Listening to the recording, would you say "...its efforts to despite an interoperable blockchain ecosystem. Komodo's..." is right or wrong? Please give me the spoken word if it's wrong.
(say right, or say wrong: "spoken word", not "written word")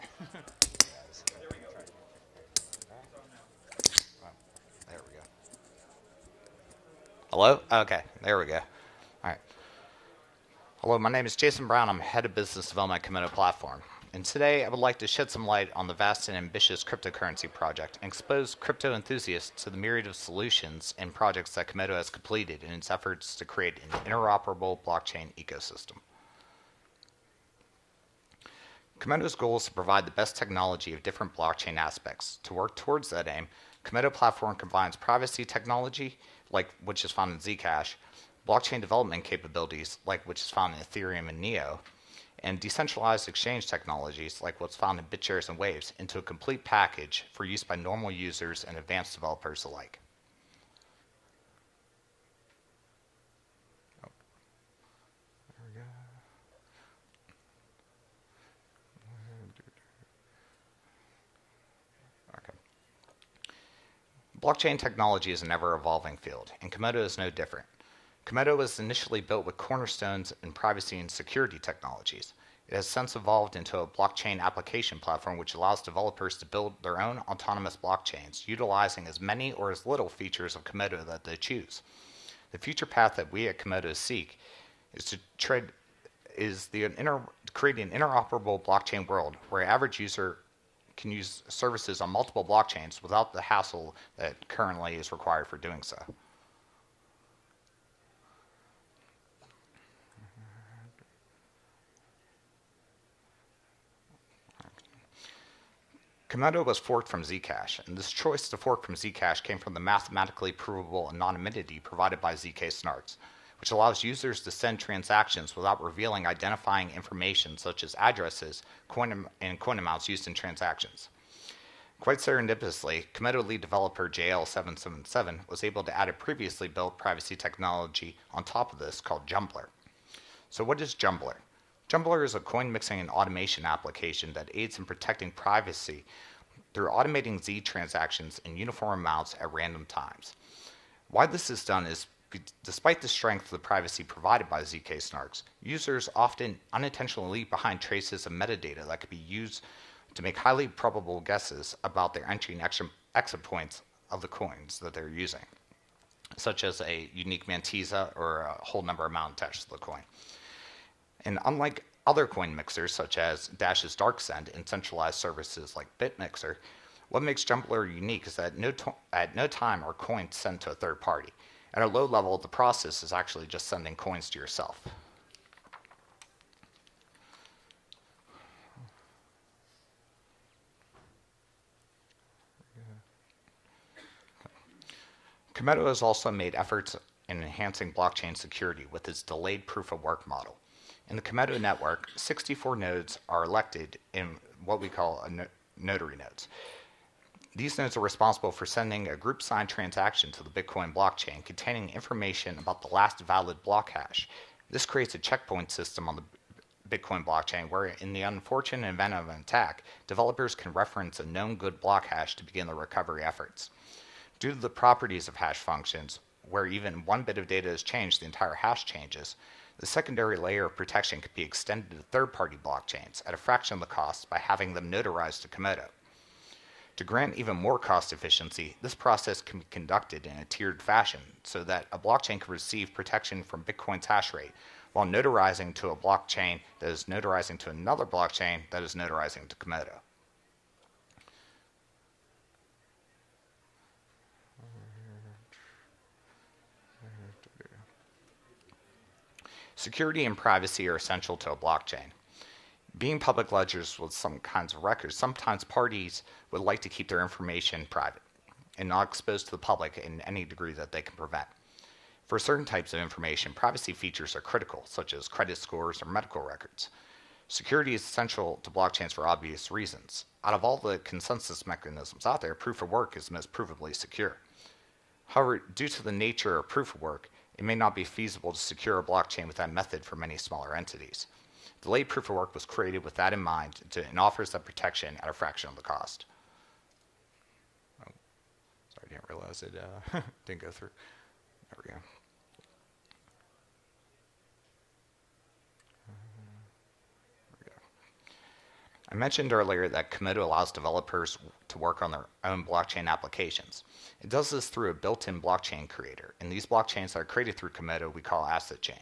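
wrong: "create", not "despite".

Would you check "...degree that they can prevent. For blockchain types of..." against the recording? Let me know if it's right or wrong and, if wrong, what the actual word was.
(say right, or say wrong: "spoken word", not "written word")
wrong: "certain", not "blockchain".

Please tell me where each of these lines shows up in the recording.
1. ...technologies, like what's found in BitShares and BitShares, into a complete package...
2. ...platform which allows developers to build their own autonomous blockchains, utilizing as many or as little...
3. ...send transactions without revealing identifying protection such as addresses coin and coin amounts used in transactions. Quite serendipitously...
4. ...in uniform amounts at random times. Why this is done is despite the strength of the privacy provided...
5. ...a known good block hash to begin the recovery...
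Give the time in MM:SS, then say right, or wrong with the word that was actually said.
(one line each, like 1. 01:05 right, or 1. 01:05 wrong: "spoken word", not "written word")
1. 00:43 wrong: "Waves", not "BitShares"
2. 01:14 right
3. 01:54 wrong: "information", not "protection"
4. 02:18 right
5. 03:31 right.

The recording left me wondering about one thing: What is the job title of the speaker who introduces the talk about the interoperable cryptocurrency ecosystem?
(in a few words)
Head of business development.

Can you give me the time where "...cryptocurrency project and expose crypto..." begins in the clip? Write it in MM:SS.
00:16.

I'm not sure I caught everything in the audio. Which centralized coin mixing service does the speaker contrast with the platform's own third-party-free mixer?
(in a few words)
BitMixer.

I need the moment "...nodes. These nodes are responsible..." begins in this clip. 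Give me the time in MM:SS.
03:16.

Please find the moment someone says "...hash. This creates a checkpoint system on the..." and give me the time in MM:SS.
03:23.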